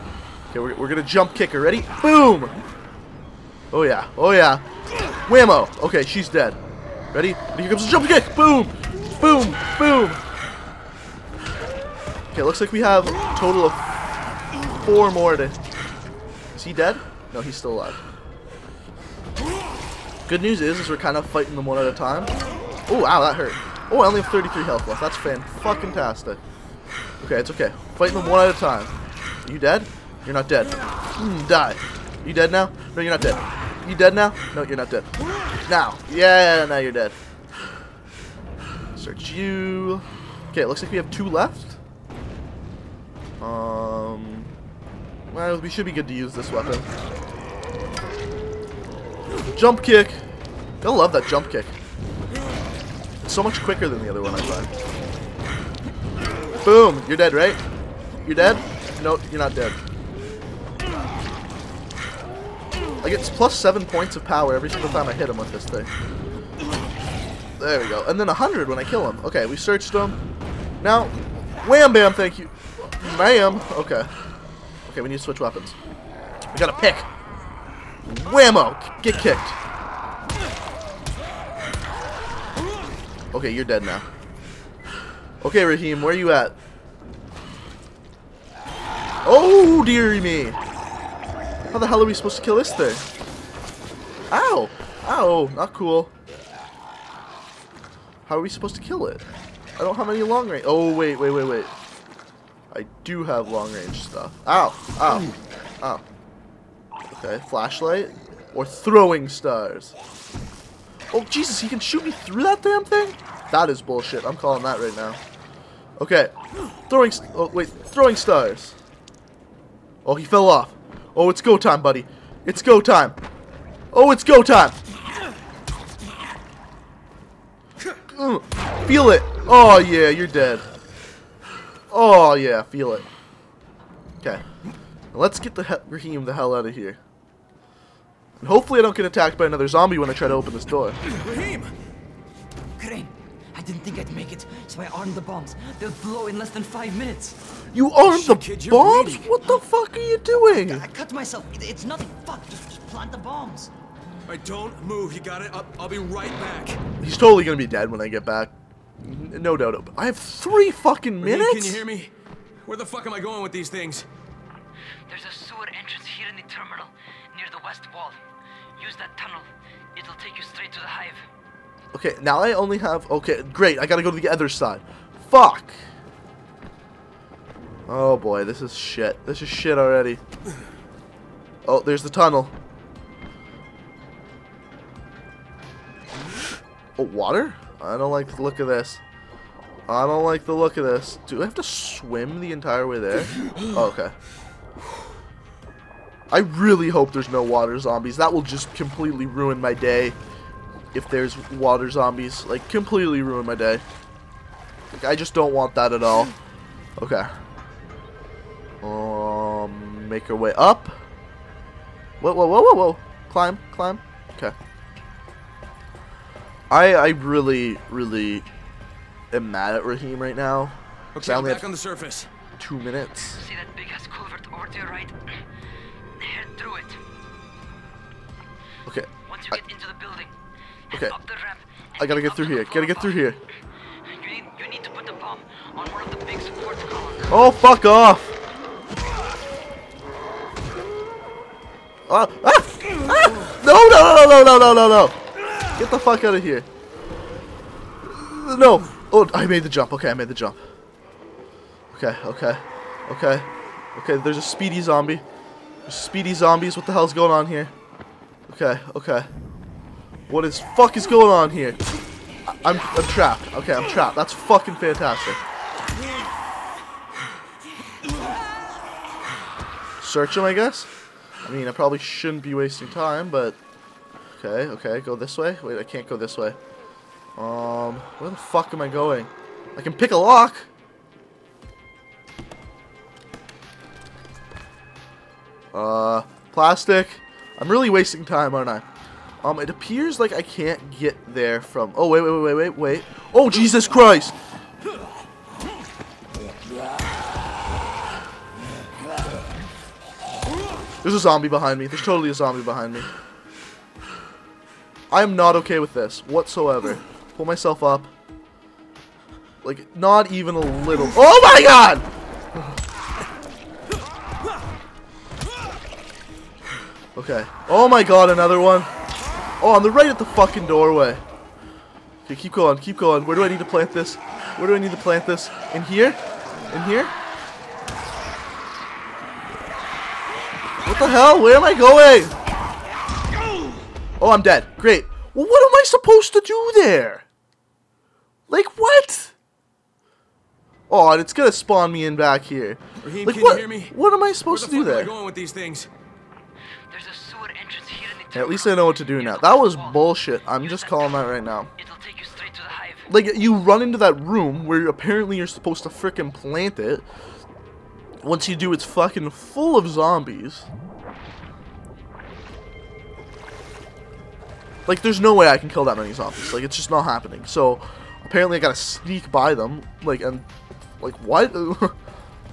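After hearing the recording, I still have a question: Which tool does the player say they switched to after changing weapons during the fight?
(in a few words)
a pick.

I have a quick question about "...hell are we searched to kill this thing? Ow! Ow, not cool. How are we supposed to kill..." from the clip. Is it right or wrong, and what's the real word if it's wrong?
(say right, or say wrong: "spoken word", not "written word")
wrong: "supposed", not "searched".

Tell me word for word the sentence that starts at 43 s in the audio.
Um, well, we should be good to use this weapon.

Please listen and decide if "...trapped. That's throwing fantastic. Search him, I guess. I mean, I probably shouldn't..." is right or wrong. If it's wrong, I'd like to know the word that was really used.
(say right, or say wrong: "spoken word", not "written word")
wrong: "fucking", not "throwing".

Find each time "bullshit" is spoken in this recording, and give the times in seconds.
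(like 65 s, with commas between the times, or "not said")
113 s, 349 s.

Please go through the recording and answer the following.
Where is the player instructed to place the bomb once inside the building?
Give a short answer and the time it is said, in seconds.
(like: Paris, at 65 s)
big support columns, at 236 s.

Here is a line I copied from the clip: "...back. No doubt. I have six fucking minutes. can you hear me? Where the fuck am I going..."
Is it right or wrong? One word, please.
wrong.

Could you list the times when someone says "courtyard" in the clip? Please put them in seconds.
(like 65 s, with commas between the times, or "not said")
not said.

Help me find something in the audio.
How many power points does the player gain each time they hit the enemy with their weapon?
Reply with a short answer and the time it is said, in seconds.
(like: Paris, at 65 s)
7, at 63 s.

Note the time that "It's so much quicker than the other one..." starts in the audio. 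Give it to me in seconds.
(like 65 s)
53 s.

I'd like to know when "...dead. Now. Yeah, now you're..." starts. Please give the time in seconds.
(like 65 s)
34 s.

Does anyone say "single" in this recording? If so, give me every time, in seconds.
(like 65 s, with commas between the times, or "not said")
64 s.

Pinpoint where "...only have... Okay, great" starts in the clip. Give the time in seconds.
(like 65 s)
172 s.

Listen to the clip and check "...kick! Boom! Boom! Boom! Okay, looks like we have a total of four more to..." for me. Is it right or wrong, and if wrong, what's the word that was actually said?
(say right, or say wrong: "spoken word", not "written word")
right.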